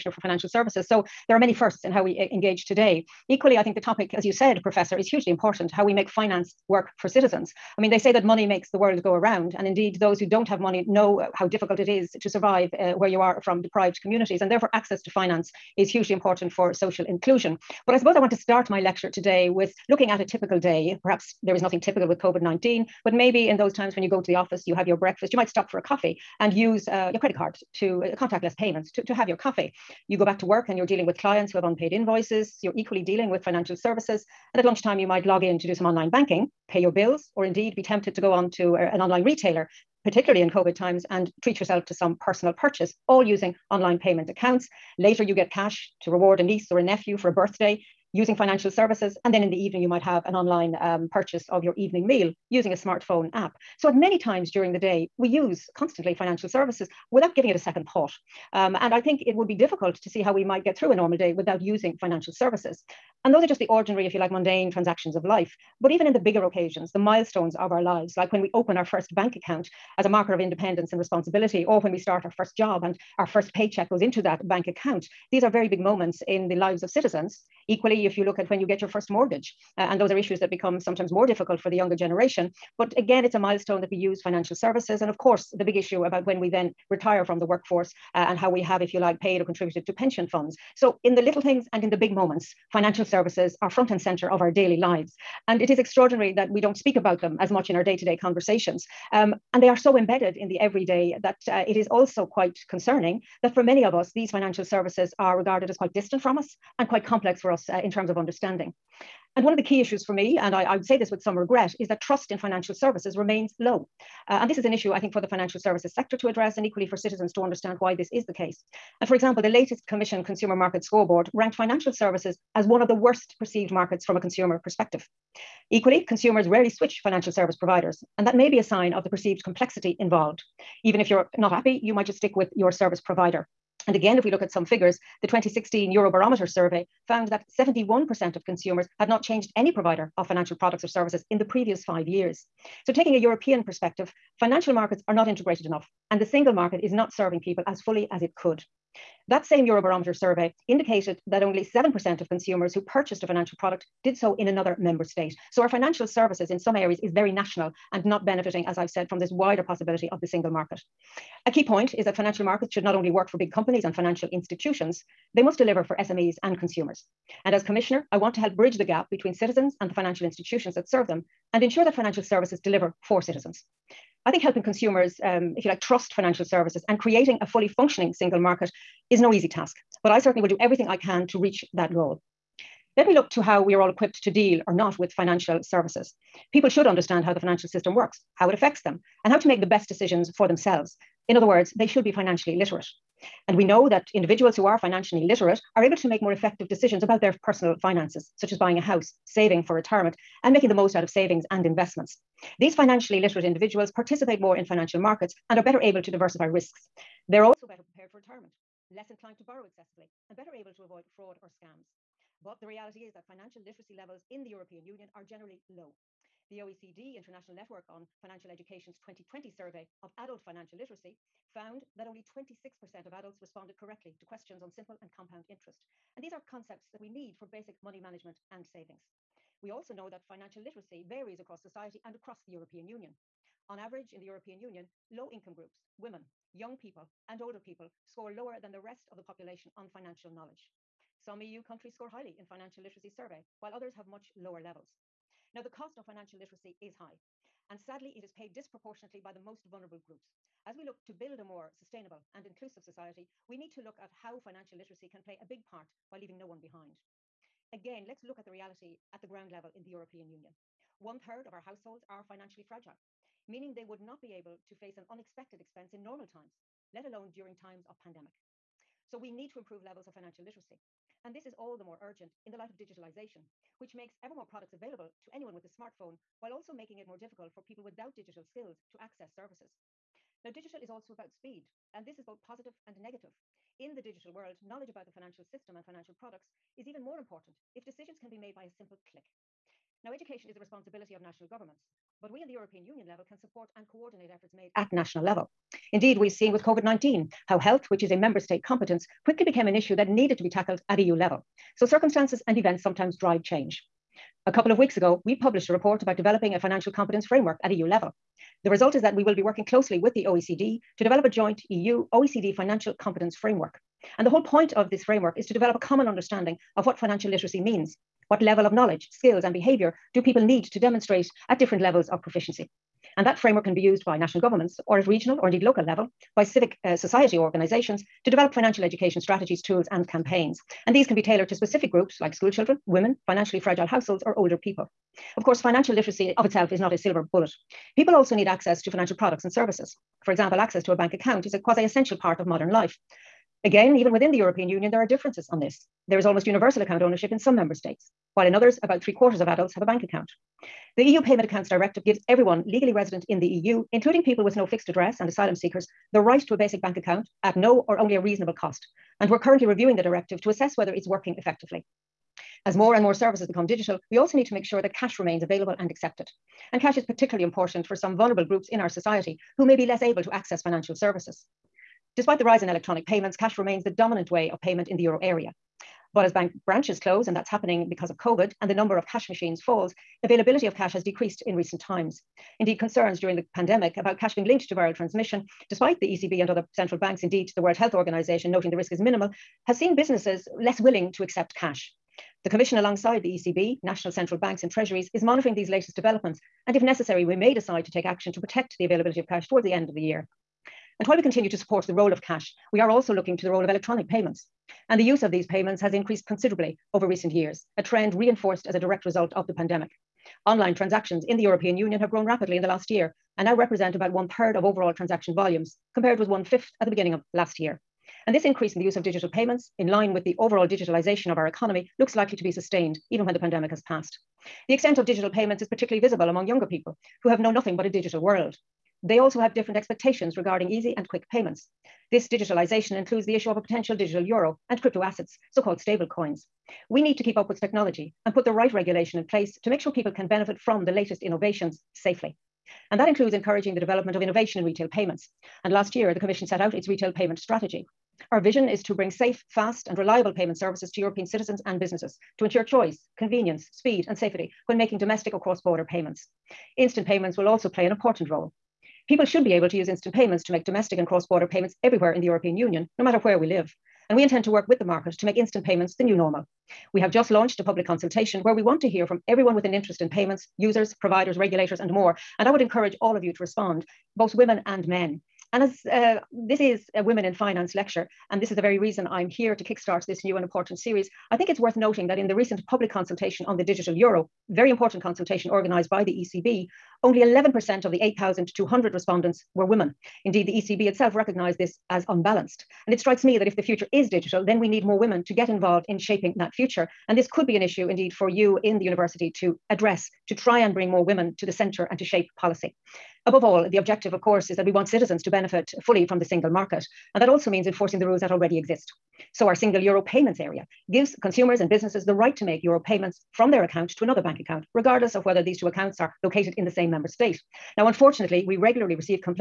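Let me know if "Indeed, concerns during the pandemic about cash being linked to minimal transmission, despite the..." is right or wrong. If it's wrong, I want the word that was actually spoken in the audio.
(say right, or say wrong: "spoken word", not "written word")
wrong: "viral", not "minimal".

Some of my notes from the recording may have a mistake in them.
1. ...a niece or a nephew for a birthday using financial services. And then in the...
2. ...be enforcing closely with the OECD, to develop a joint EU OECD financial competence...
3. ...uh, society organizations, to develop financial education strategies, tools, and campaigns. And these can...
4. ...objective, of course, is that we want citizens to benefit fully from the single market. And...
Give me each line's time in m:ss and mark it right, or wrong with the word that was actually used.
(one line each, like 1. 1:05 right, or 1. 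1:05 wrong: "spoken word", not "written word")
1. 0:46 right
2. 5:09 wrong: "working", not "enforcing"
3. 5:26 right
4. 8:23 right.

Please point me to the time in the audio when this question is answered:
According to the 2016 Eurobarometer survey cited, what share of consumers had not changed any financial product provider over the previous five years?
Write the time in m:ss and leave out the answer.
2:17.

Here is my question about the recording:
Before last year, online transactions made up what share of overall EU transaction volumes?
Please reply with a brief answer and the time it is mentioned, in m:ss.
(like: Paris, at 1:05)
One fifth, at 6:56.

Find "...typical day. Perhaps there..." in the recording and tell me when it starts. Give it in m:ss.
0:20.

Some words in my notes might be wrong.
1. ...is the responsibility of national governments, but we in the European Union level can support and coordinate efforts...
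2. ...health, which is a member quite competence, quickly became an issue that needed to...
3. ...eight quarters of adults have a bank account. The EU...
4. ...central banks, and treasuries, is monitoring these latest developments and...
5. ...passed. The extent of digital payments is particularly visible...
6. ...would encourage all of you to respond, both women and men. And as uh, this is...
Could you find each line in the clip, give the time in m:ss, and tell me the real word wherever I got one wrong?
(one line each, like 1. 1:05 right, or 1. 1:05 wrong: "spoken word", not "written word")
1. 4:50 right
2. 4:57 wrong: "state", not "quite"
3. 5:49 wrong: "three", not "eight"
4. 6:34 right
5. 7:03 right
6. 7:52 right.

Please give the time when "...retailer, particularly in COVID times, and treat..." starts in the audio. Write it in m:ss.
0:39.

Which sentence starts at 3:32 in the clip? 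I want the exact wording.
But the reality is that financial literacy levels in the European Union are generally low.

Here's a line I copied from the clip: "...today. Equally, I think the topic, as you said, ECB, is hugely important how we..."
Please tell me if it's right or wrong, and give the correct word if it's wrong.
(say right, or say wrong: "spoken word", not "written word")
wrong: "Professor", not "ECB".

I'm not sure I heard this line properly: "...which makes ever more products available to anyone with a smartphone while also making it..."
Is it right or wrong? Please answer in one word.
right.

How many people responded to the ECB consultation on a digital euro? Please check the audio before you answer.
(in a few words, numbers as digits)
8,200.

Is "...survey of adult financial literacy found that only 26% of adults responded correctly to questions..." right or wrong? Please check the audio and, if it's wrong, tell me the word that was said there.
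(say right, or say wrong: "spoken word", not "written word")
right.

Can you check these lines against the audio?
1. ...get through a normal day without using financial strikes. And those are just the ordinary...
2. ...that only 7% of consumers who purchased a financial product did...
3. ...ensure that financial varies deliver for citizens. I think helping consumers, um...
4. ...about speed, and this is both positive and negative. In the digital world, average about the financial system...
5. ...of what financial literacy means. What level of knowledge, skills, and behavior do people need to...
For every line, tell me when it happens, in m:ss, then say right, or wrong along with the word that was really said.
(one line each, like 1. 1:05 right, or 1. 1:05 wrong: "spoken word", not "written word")
1. 1:00 wrong: "services", not "strikes"
2. 2:31 right
3. 2:51 wrong: "services", not "varies"
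4. 4:41 wrong: "knowledge", not "average"
5. 5:16 right.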